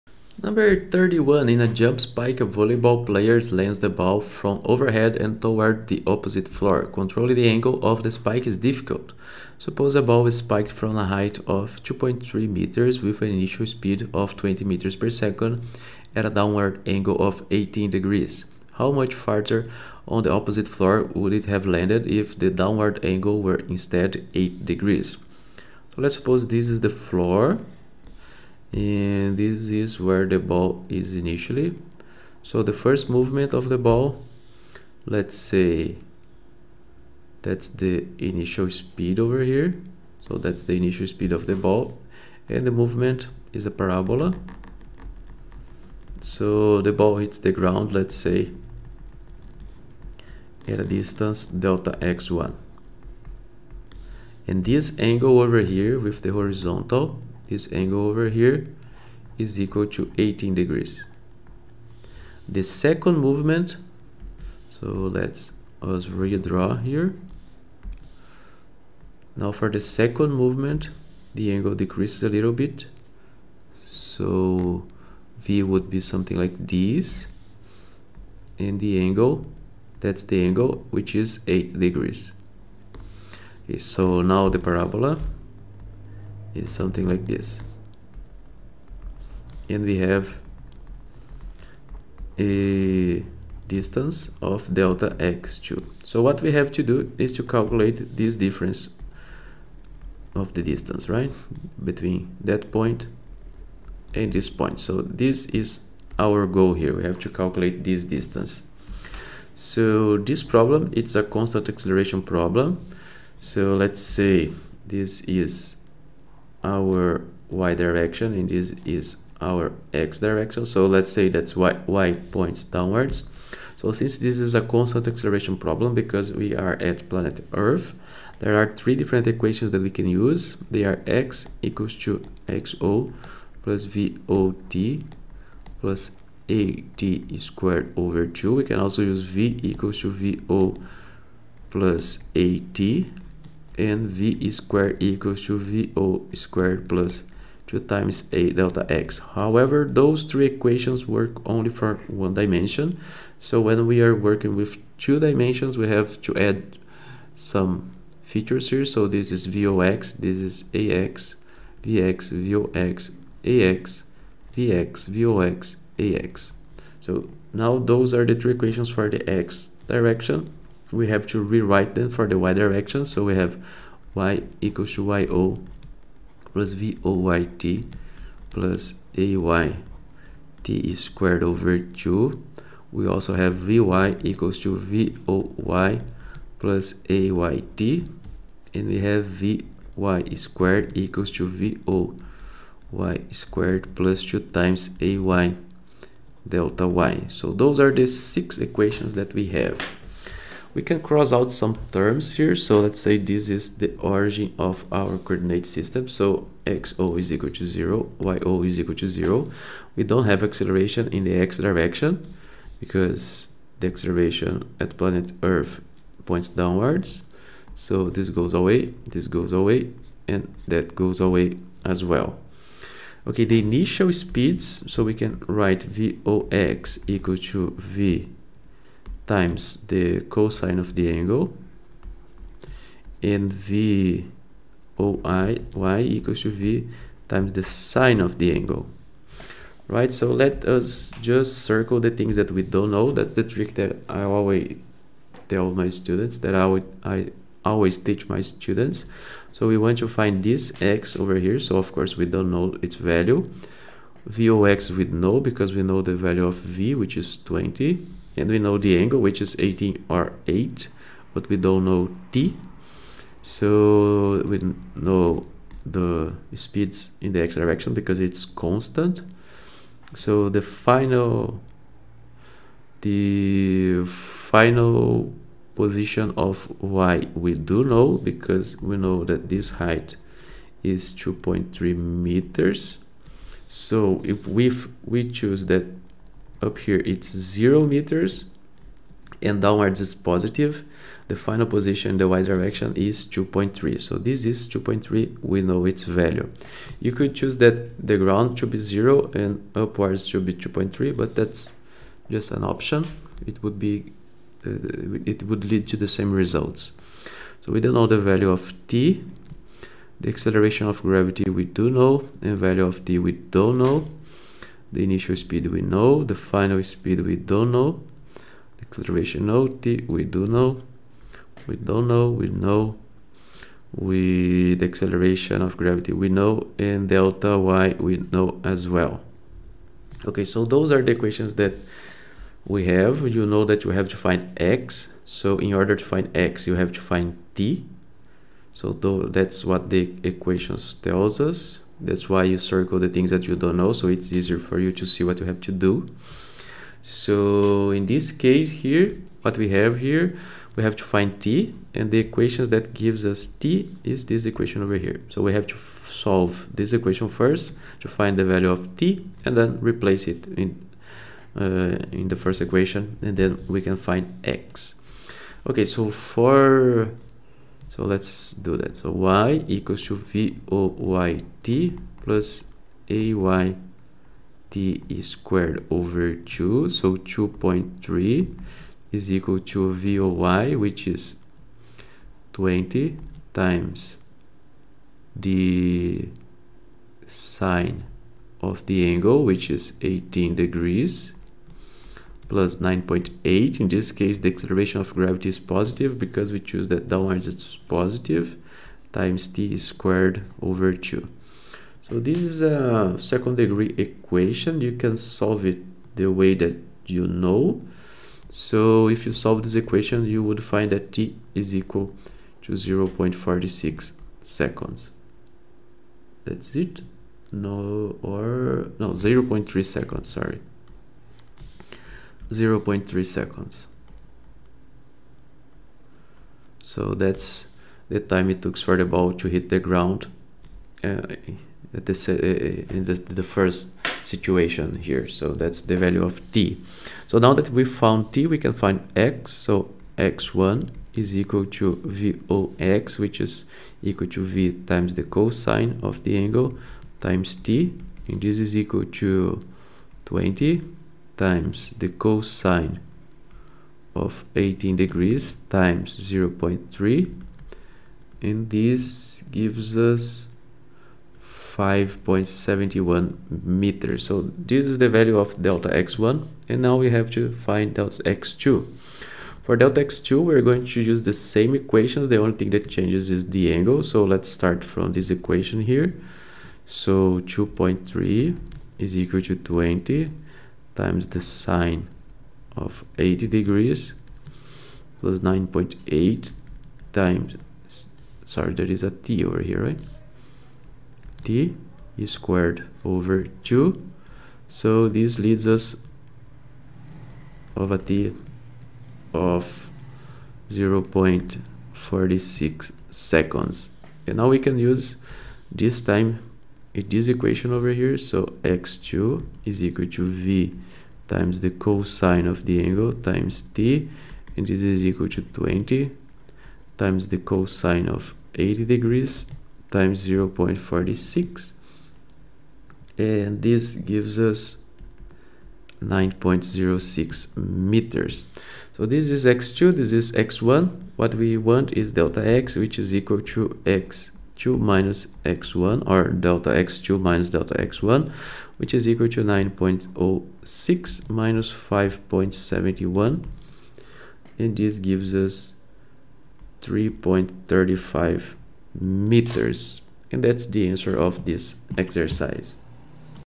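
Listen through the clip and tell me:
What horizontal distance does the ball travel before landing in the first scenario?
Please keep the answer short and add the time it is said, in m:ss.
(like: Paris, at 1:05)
5.71 meters, at 7:41.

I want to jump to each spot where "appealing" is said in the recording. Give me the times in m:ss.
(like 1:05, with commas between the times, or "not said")
not said.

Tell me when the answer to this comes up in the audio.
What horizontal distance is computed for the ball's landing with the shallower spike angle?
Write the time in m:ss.
8:46.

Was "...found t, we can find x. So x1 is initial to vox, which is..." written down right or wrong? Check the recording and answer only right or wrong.
wrong.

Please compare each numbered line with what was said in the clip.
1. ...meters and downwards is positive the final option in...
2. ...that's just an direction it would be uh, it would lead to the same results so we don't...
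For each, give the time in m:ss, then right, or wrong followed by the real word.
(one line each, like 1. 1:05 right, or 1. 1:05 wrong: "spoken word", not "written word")
1. 4:47 wrong: "position", not "option"
2. 5:01 wrong: "option", not "direction".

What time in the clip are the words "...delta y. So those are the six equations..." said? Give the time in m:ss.
3:16.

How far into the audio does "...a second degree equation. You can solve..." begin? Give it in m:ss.
6:42.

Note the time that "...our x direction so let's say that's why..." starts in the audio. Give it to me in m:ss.
1:59.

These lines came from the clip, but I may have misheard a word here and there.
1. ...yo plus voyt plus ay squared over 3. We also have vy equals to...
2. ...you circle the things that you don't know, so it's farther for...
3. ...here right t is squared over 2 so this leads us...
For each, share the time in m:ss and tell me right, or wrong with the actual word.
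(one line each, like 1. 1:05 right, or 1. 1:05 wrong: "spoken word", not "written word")
1. 2:55 wrong: "2", not "3"
2. 5:42 wrong: "easier", not "farther"
3. 8:09 right.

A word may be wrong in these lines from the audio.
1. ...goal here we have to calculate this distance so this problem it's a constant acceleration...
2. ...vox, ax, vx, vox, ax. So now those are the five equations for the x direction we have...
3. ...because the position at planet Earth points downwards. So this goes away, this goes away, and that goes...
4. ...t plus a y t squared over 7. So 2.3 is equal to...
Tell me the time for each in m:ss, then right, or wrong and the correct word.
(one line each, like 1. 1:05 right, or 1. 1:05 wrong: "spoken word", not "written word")
1. 1:46 right
2. 2:42 wrong: "three", not "five"
3. 3:32 wrong: "acceleration", not "position"
4. 6:11 wrong: "2", not "7".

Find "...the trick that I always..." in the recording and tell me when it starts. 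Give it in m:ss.
4:03.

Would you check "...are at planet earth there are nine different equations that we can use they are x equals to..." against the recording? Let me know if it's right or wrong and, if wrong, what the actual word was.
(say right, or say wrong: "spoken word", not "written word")
wrong: "three", not "nine".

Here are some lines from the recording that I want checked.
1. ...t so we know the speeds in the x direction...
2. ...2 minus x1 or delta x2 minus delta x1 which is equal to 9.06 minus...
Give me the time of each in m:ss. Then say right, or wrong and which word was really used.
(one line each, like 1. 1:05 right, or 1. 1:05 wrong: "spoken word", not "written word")
1. 4:22 right
2. 8:54 right.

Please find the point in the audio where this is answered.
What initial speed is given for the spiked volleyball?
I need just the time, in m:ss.
0:14.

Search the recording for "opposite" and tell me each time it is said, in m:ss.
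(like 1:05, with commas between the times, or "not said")
0:06, 0:20.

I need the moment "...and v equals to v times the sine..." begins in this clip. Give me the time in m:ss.
3:53.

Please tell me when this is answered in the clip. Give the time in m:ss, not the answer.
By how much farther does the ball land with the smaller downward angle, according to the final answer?
9:06.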